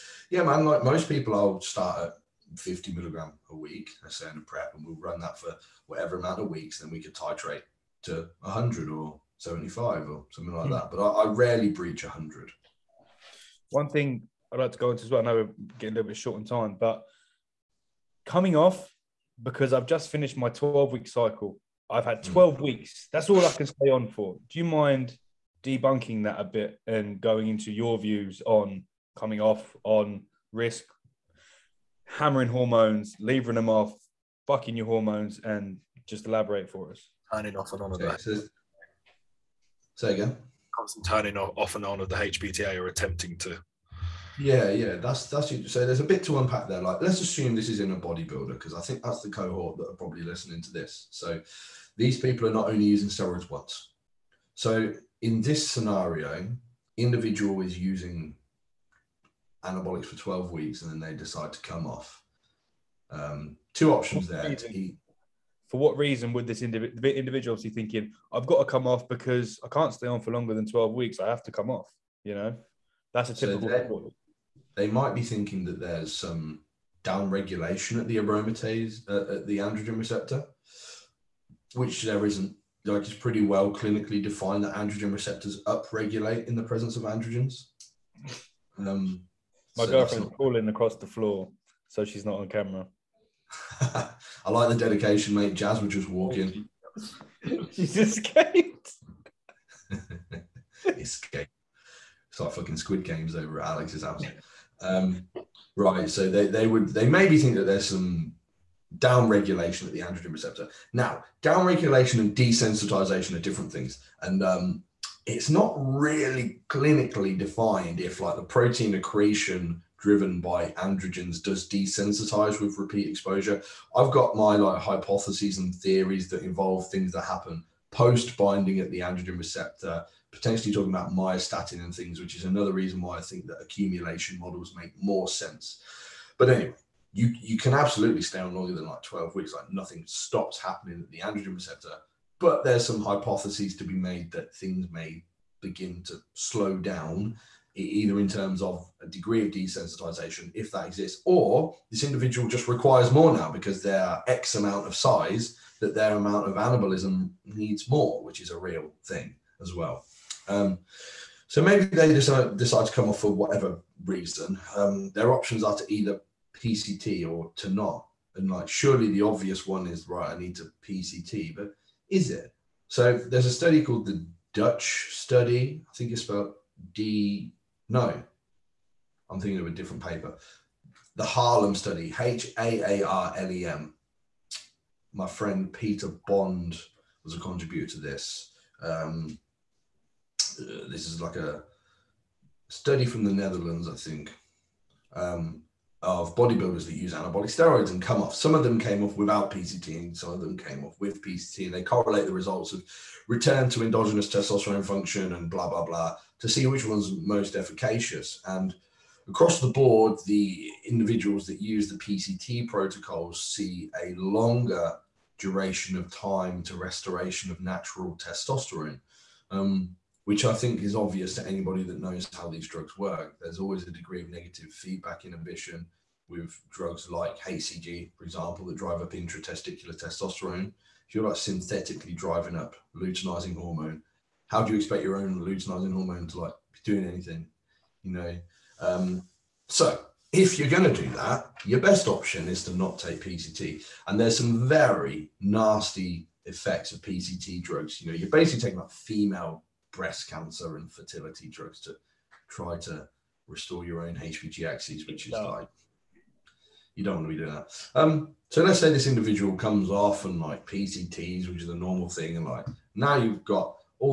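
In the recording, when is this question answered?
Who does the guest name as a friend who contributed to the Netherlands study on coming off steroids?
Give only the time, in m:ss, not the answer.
3:05.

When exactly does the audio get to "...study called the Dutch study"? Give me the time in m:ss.
2:53.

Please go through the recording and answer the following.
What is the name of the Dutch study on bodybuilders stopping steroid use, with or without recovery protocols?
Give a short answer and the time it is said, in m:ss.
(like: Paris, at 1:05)
Harlem study, at 3:01.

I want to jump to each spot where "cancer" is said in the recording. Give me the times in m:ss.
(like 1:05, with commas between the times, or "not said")
4:10.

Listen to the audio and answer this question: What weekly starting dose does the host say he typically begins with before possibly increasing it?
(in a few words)
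50 milligrams.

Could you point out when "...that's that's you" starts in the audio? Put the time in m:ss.
0:44.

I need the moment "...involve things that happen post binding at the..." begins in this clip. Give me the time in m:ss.
2:06.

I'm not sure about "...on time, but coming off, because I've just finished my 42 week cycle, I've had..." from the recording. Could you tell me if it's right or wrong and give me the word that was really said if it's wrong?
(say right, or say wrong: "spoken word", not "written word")
wrong: "12", not "42".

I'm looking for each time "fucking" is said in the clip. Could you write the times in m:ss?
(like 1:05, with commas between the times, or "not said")
0:34, 1:42.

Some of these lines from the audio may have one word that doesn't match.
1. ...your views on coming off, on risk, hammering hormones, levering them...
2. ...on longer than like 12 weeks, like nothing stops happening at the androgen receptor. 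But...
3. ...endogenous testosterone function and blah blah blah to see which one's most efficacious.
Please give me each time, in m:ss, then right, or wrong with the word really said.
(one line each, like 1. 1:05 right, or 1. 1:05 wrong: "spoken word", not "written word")
1. 0:27 right
2. 2:18 right
3. 3:23 right.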